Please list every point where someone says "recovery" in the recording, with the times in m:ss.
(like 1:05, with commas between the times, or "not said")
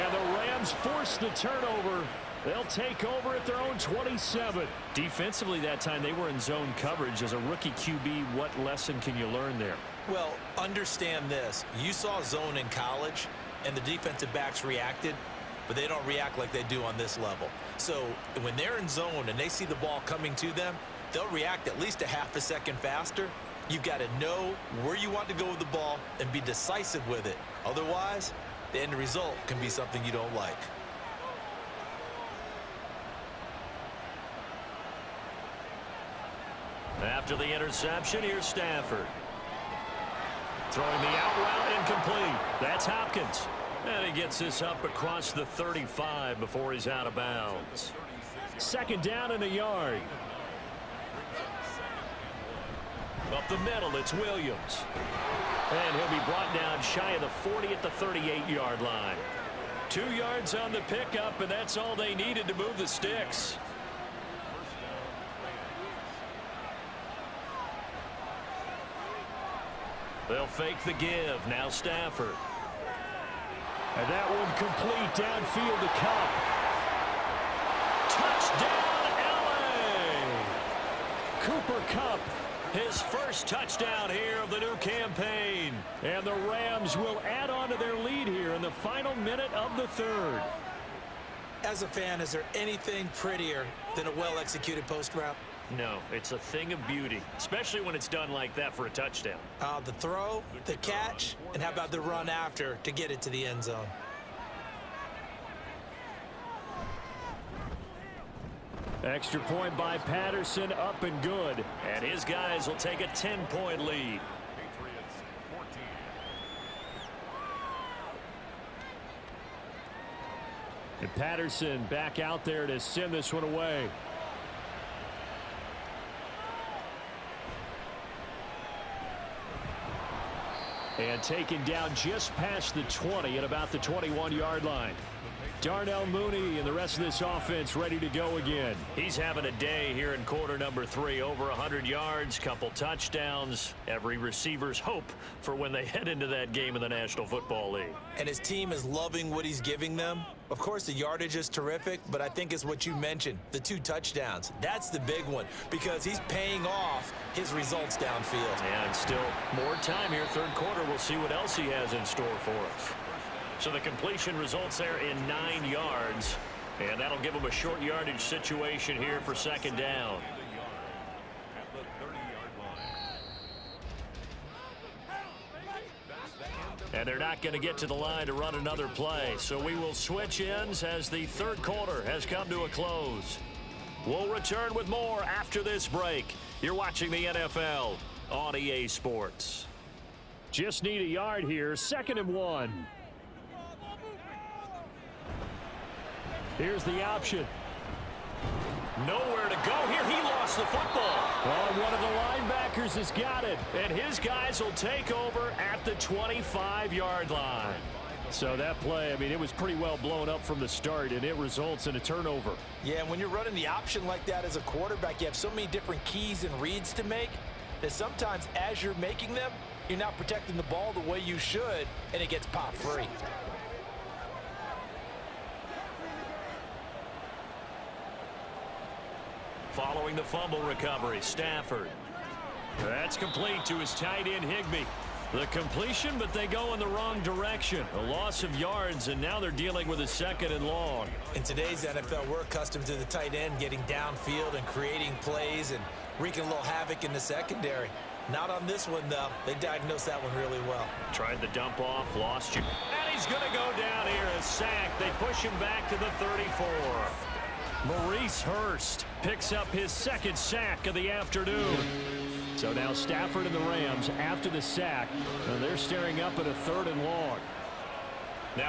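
3:50.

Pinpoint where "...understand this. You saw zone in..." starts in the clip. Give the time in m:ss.
0:10.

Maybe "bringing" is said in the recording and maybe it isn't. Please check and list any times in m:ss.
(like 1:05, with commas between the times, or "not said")
not said.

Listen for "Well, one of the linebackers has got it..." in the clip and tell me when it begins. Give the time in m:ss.
3:21.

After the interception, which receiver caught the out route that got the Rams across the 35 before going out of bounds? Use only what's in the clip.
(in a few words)
Hopkins.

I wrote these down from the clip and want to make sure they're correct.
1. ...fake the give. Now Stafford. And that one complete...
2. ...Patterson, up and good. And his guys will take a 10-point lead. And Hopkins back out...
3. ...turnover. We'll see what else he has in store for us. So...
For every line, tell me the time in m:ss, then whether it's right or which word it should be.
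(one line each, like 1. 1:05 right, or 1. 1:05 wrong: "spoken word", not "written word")
1. 1:10 right
2. 1:49 wrong: "Patterson", not "Hopkins"
3. 2:40 wrong: "quarter", not "turnover".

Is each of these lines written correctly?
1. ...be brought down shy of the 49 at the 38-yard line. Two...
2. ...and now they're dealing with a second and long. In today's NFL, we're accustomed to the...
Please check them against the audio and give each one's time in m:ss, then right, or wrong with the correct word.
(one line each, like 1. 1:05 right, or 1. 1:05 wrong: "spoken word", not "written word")
1. 0:56 wrong: "40", not "49"
2. 3:59 right.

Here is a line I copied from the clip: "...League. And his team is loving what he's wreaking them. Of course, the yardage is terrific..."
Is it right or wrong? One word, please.
wrong.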